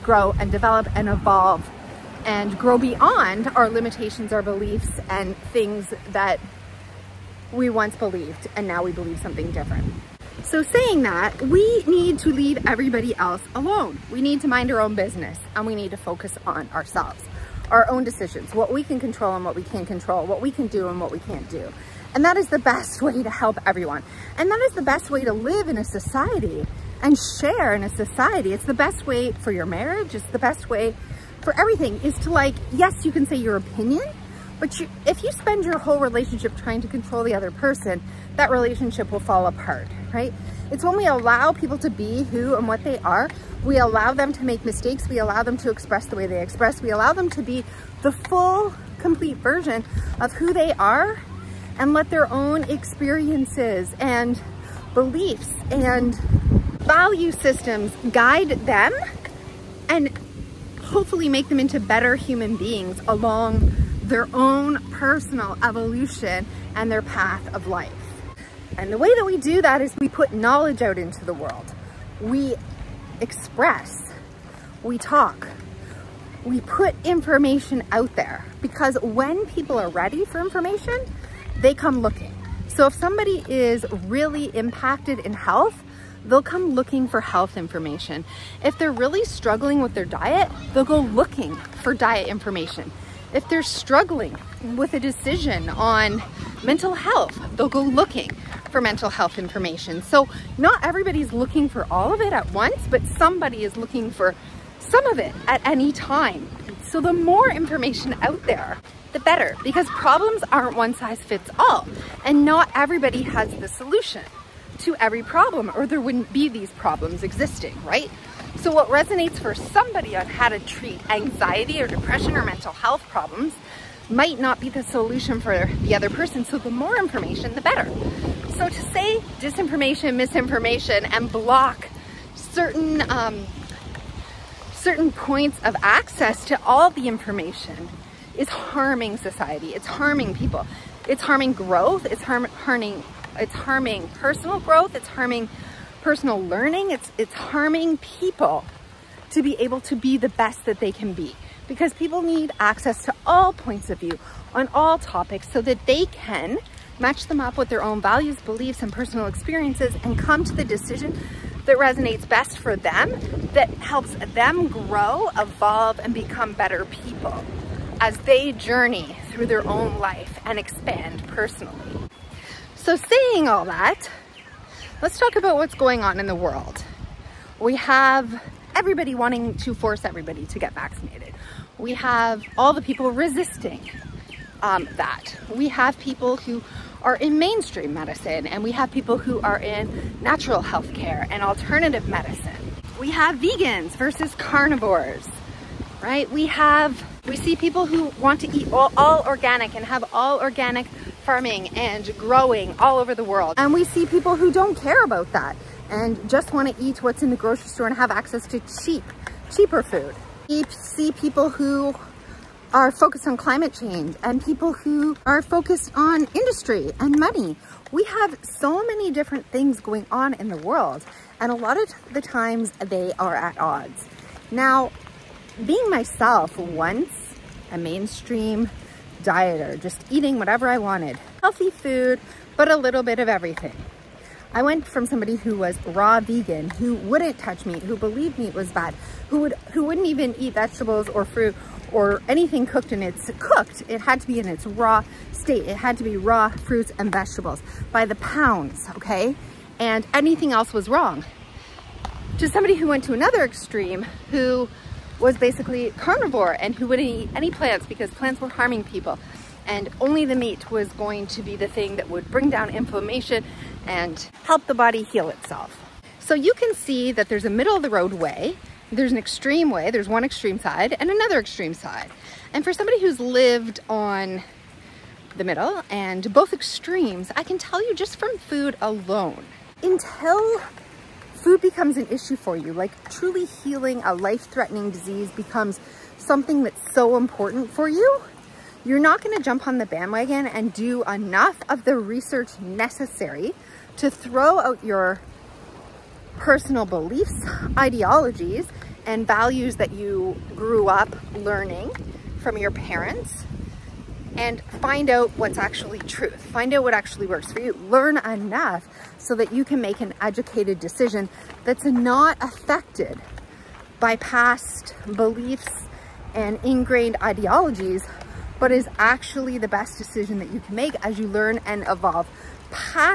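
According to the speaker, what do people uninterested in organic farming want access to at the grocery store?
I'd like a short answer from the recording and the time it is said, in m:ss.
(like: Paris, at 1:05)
cheaper food, at 3:29.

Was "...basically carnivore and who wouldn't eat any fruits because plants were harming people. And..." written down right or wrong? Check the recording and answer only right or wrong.
wrong.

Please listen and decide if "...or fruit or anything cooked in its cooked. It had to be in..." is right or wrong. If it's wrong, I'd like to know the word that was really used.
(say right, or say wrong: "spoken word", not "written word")
right.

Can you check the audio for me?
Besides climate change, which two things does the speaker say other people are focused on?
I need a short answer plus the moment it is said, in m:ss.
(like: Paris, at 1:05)
industry and money, at 3:36.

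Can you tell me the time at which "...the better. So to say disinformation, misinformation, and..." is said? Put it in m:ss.
2:07.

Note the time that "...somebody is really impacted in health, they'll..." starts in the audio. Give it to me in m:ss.
1:22.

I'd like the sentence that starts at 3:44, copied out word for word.
Now, being myself once a mainstream dieter, just eating whatever I wanted.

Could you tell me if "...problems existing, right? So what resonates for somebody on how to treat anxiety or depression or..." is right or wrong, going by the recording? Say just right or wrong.
right.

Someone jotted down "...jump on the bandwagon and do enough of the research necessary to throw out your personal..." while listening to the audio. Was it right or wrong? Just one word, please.
right.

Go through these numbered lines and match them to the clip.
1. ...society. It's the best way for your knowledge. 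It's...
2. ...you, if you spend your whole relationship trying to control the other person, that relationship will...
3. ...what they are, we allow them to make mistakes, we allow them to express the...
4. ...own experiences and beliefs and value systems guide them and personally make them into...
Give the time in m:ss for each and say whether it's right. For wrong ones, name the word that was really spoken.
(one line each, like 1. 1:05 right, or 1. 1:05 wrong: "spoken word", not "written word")
1. 0:27 wrong: "marriage", not "knowledge"
2. 0:34 right
3. 0:42 right
4. 0:52 wrong: "hopefully", not "personally".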